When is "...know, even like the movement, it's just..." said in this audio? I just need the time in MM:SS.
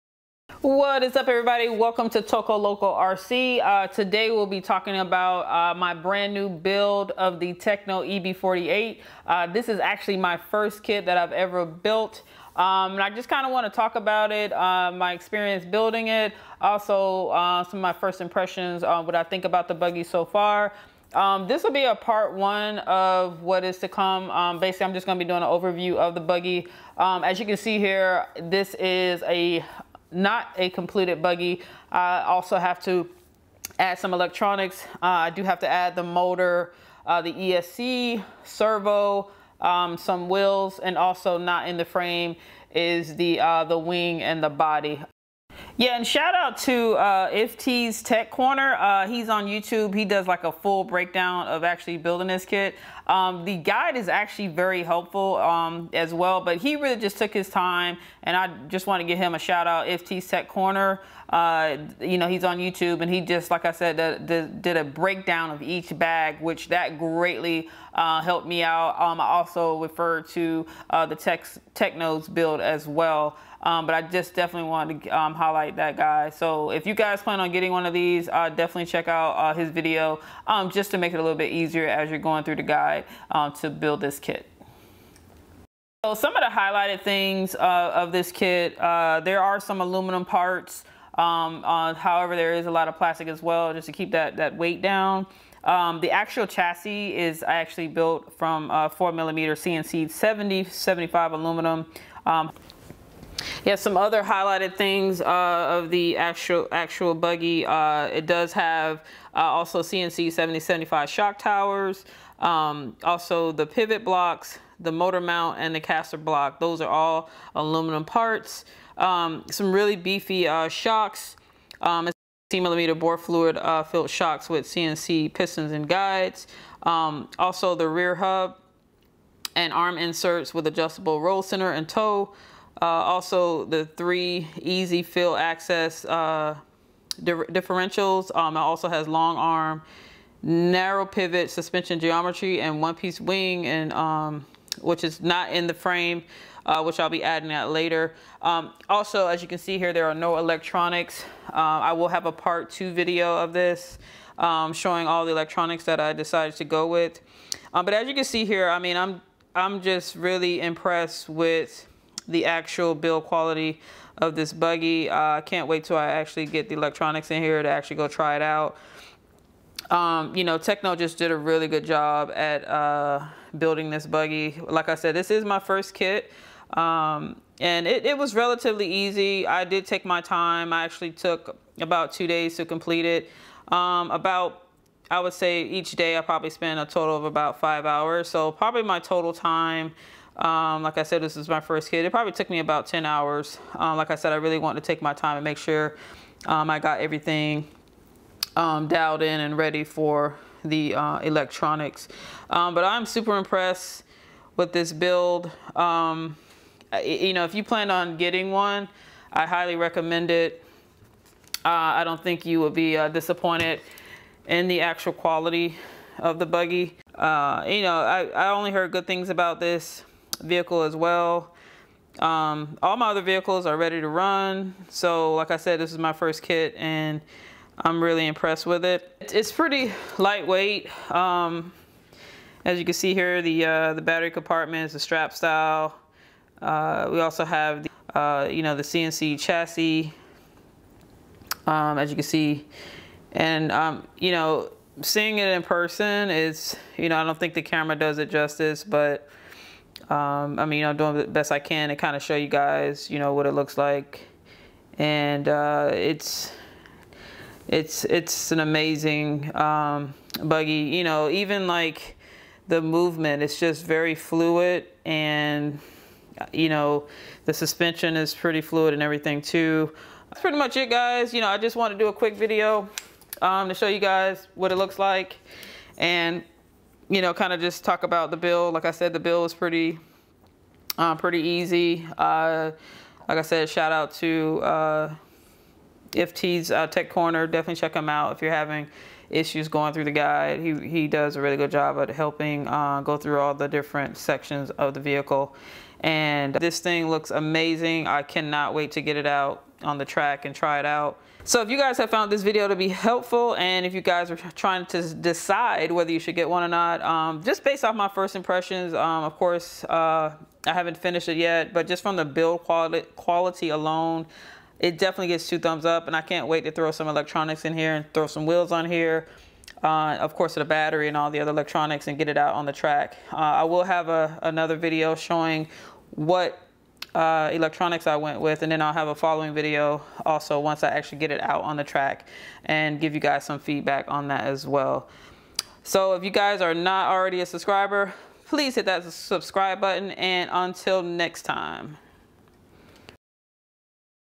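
04:21.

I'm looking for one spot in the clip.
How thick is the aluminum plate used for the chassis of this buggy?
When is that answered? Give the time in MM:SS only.
01:38.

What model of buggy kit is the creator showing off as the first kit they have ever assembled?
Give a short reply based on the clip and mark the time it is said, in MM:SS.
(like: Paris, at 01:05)
Tekno EB48, at 00:07.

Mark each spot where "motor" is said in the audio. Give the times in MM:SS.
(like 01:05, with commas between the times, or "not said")
00:36, 01:54.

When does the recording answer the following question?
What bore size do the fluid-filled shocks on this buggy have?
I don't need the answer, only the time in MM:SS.
02:02.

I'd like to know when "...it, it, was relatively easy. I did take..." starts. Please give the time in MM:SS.
02:57.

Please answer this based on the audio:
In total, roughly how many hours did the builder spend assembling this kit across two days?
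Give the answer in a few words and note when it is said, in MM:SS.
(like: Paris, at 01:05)
10 hours, at 03:12.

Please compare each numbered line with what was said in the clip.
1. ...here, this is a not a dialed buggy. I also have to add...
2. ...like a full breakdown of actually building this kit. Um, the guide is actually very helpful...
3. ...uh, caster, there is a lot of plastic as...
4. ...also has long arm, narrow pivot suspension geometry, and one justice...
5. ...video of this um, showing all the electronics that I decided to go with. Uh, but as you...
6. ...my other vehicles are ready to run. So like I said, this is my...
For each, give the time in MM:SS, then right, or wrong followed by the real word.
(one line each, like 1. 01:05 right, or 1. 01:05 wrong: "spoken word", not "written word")
1. 00:27 wrong: "completed", not "dialed"
2. 00:50 right
3. 01:31 wrong: "however", not "caster"
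4. 02:18 wrong: "piece", not "justice"
5. 02:32 right
6. 03:42 right.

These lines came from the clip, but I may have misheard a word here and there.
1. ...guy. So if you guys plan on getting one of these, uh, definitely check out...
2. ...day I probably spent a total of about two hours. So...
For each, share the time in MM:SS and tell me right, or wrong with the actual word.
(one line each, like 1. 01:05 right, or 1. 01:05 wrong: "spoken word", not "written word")
1. 01:15 right
2. 03:05 wrong: "five", not "two".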